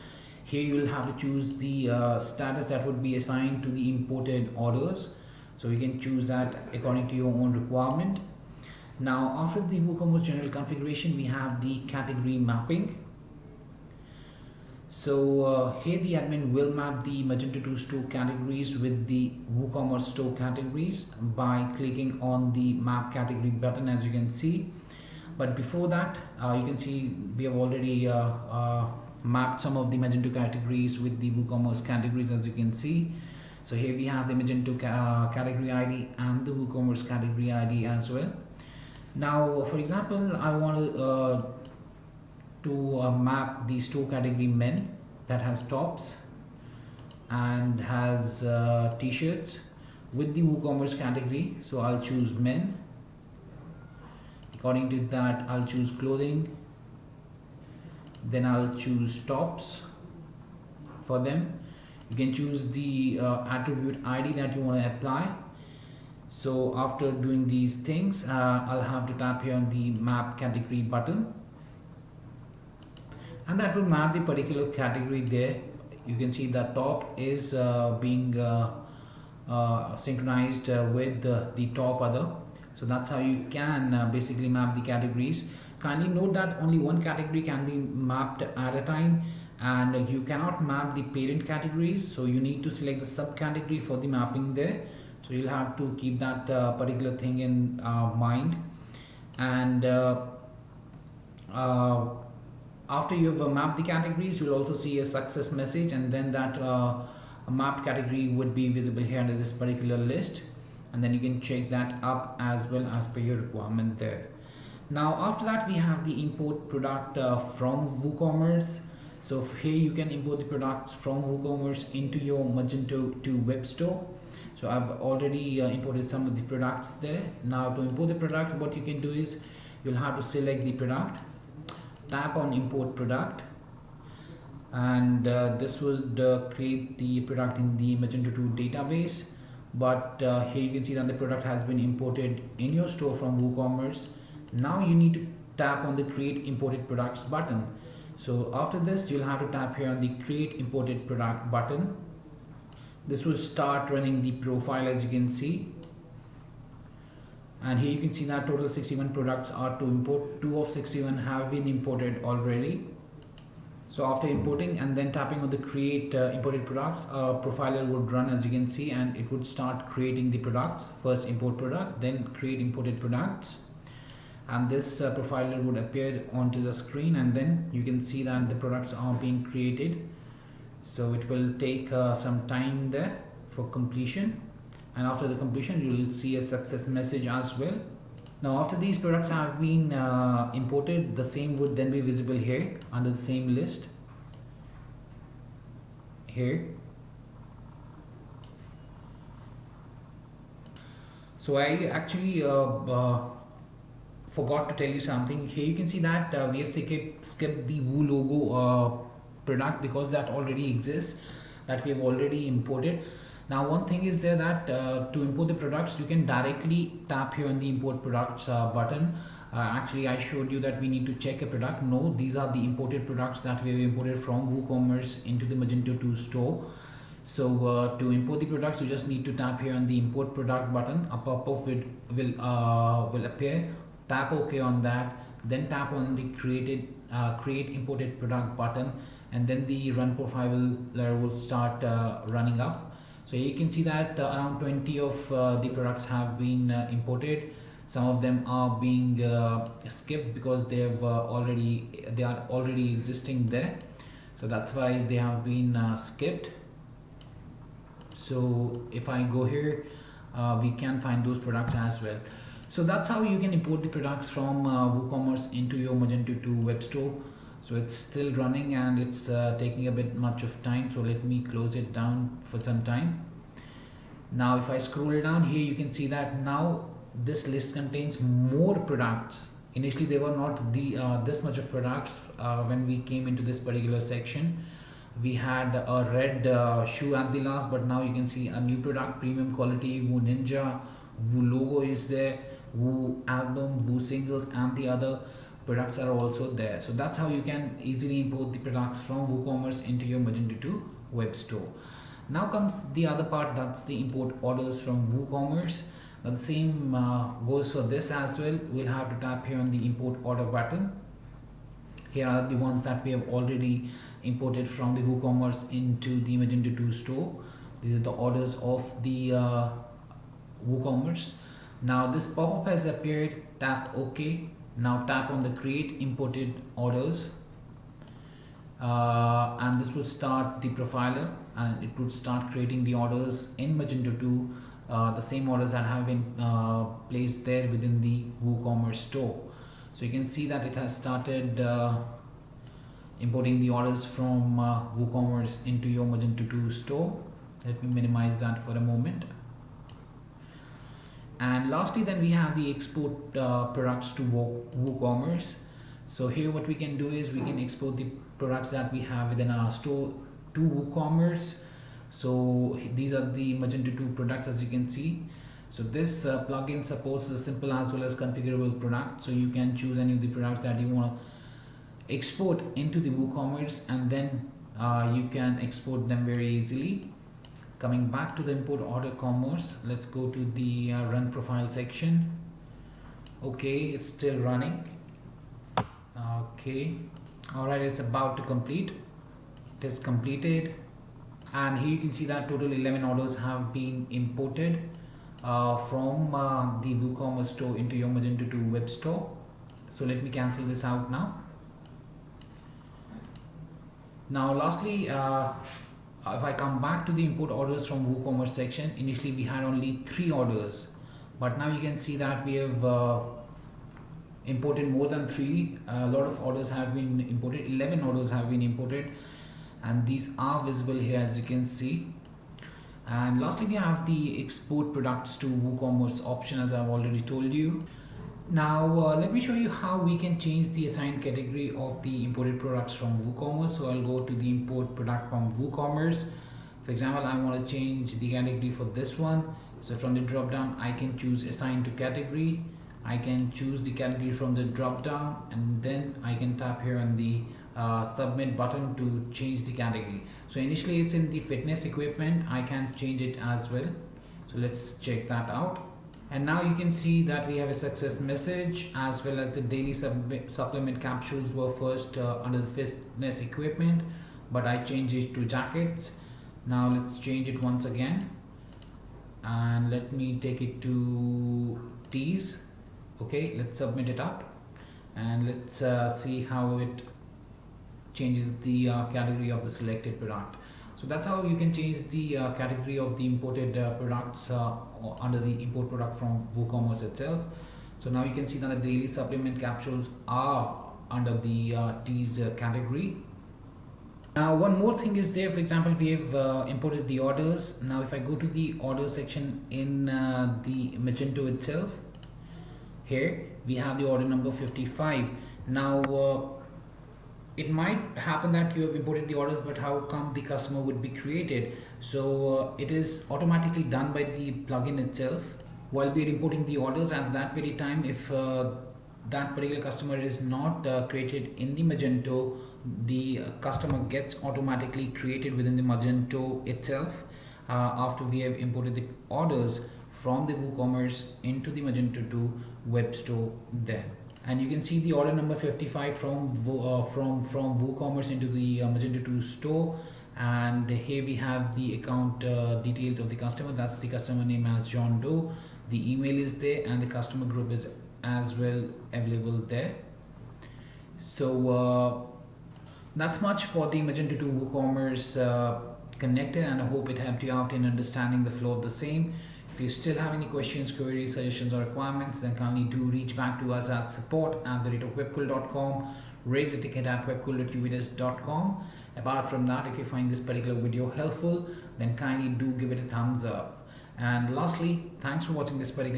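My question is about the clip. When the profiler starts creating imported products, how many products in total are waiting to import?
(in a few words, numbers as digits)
61.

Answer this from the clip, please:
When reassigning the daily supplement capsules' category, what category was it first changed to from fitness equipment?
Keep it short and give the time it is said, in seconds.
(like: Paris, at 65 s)
Jackets, at 465 s.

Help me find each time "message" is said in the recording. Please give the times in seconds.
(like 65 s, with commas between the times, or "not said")
105 s, 186 s, 458 s.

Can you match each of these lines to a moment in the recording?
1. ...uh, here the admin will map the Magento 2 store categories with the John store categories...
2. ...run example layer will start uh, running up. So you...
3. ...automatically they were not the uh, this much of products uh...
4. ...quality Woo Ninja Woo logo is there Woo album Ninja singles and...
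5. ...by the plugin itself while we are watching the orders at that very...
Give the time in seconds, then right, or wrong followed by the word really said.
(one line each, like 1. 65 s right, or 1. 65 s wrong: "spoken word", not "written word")
1. 15 s wrong: "WooCommerce", not "John"
2. 239 s wrong: "profile", not "example"
3. 279 s wrong: "initially", not "automatically"
4. 289 s wrong: "Woo", not "Ninja"
5. 514 s wrong: "importing", not "watching".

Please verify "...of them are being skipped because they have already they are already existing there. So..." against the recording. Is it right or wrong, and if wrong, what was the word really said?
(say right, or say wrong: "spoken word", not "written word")
right.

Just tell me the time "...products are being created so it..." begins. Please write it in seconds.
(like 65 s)
178 s.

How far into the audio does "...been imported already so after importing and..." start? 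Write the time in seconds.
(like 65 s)
161 s.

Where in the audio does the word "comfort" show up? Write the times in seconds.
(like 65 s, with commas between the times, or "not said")
not said.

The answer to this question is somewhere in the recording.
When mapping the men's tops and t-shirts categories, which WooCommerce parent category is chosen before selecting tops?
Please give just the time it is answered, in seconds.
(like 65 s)
55 s.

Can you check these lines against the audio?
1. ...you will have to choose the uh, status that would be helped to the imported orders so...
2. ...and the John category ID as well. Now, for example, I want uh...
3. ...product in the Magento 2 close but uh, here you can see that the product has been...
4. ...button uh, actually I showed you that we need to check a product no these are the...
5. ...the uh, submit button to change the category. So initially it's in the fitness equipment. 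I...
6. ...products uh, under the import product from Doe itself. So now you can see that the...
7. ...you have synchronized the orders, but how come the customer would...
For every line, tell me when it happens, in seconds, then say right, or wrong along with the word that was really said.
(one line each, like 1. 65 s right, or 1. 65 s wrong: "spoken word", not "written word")
1. 0 s wrong: "assigned", not "helped"
2. 36 s wrong: "WooCommerce", not "John"
3. 137 s wrong: "database", not "close"
4. 218 s right
5. 447 s right
6. 483 s wrong: "WooCommerce", not "Doe"
7. 508 s wrong: "imported", not "synchronized".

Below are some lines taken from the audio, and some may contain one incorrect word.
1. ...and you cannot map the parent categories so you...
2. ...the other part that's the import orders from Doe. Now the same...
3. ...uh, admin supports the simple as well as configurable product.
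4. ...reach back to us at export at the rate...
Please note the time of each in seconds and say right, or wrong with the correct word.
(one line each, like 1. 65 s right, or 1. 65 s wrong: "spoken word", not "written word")
1. 89 s right
2. 302 s wrong: "WooCommerce", not "Doe"
3. 366 s wrong: "plugin", not "admin"
4. 563 s wrong: "support", not "export".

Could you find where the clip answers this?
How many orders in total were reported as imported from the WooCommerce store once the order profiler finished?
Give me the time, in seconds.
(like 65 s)
392 s.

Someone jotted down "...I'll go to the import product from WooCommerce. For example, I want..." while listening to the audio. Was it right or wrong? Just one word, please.
right.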